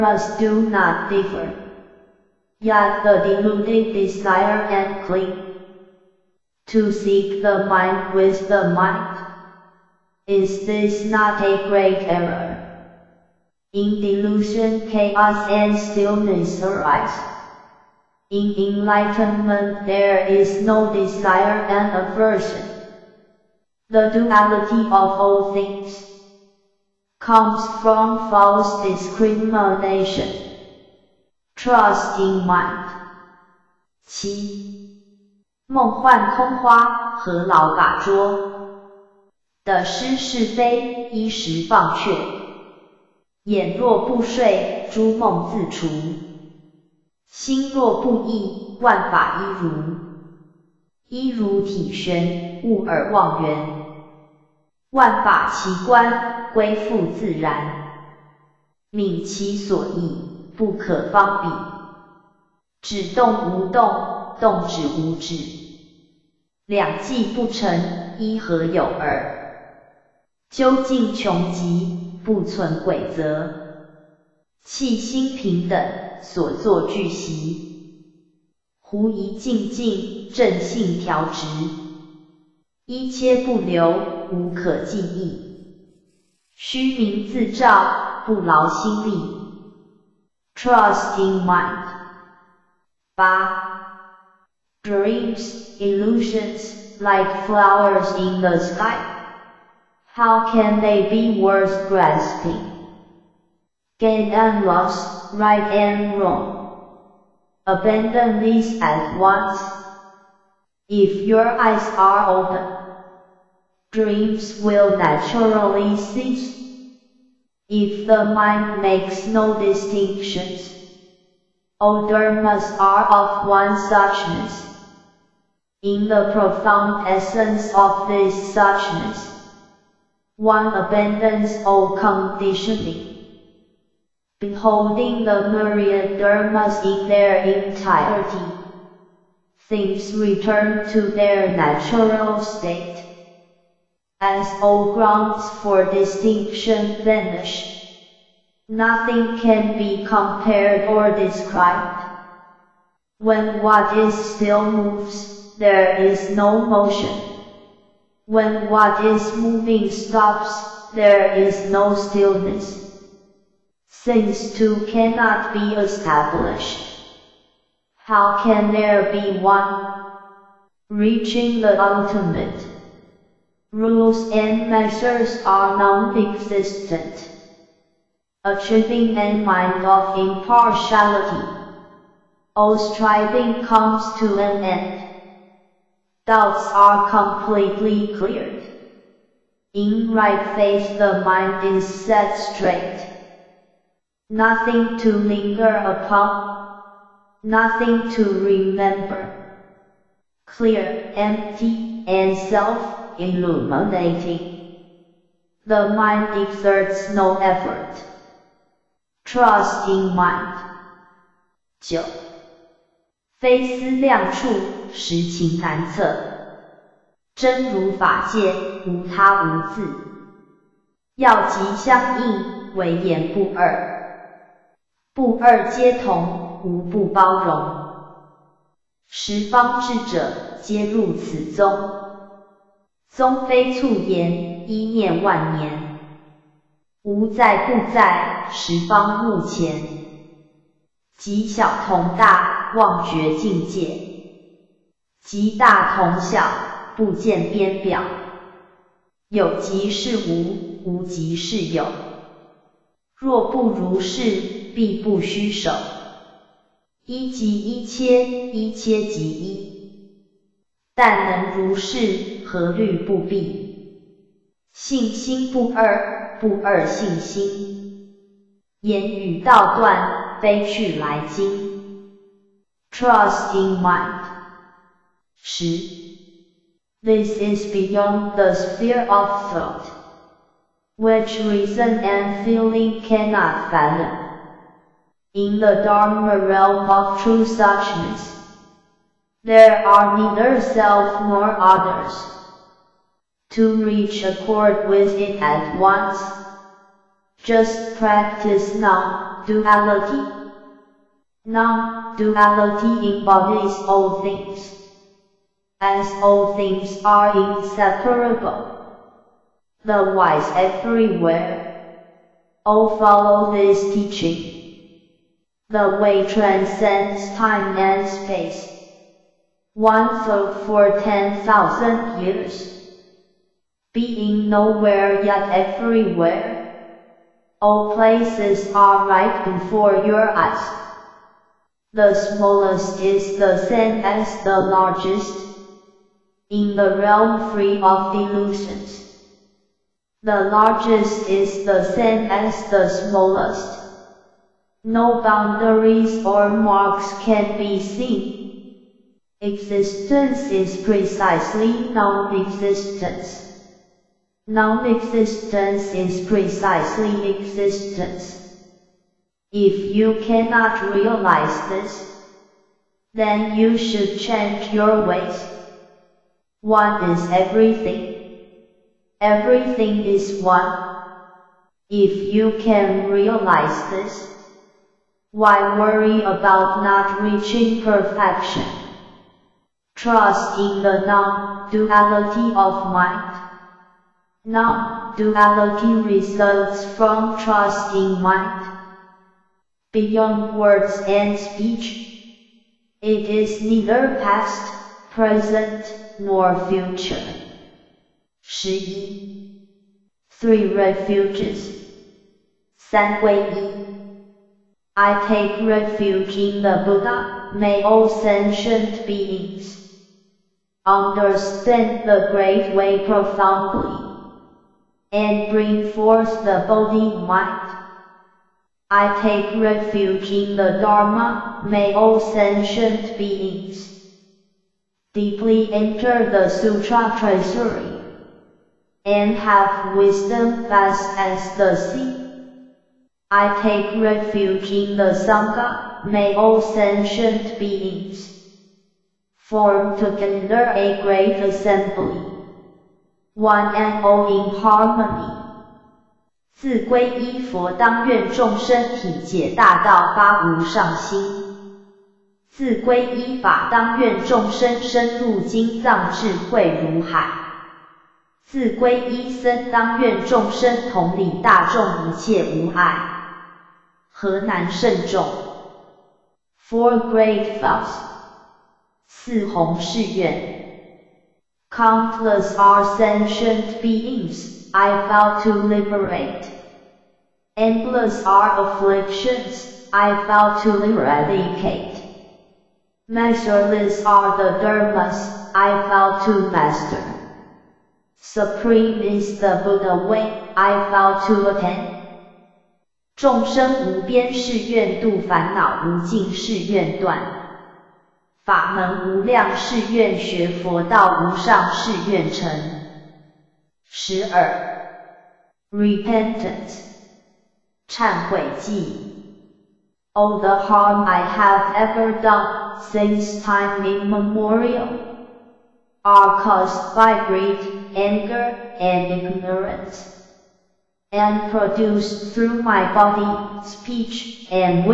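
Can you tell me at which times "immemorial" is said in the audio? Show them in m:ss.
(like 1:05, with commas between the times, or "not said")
8:33.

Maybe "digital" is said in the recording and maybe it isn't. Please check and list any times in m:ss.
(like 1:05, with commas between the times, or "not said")
not said.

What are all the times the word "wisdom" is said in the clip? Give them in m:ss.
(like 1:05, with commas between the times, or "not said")
7:09.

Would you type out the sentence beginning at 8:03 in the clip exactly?
Measureless are the dharmas I vow to master.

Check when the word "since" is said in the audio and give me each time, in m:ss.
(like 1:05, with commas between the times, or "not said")
2:43, 8:32.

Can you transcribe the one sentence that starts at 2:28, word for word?
Nothing can be compared or described.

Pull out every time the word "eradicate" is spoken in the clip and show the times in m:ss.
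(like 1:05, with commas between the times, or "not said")
8:00.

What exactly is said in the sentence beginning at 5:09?
The wise everywhere all follow this teaching.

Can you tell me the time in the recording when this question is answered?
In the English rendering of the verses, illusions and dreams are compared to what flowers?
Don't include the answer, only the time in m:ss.
1:37.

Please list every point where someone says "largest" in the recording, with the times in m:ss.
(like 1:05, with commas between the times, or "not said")
5:34, 5:40.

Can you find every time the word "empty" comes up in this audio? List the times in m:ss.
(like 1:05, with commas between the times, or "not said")
3:21.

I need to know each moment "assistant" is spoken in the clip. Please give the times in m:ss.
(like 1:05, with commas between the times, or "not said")
not said.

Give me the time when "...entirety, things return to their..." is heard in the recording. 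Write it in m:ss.
2:17.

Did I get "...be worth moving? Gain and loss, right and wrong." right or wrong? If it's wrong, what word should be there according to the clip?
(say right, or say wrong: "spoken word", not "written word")
wrong: "grasping", not "moving".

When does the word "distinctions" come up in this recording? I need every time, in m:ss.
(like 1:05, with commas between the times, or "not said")
1:59, 2:25.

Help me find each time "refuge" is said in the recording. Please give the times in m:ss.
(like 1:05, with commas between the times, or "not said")
6:45, 6:59, 7:14.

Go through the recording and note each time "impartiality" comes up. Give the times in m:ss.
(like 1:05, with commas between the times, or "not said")
3:00.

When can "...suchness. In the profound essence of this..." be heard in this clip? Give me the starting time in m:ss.
2:03.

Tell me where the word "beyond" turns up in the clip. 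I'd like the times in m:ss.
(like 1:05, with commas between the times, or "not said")
4:37, 6:29.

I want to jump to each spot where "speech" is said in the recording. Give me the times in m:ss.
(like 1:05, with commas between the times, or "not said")
6:31, 8:43.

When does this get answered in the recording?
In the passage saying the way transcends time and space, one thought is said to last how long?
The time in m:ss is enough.
5:20.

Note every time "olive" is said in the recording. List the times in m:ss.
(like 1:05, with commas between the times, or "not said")
not said.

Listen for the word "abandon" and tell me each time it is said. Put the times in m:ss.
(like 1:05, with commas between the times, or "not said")
1:47, 2:10.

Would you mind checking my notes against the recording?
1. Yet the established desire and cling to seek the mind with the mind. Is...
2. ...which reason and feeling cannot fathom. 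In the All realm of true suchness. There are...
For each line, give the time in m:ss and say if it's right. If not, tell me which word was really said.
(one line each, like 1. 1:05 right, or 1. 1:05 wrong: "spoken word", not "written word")
1. 0:02 wrong: "deluded", not "established"
2. 4:40 wrong: "Dharma", not "All".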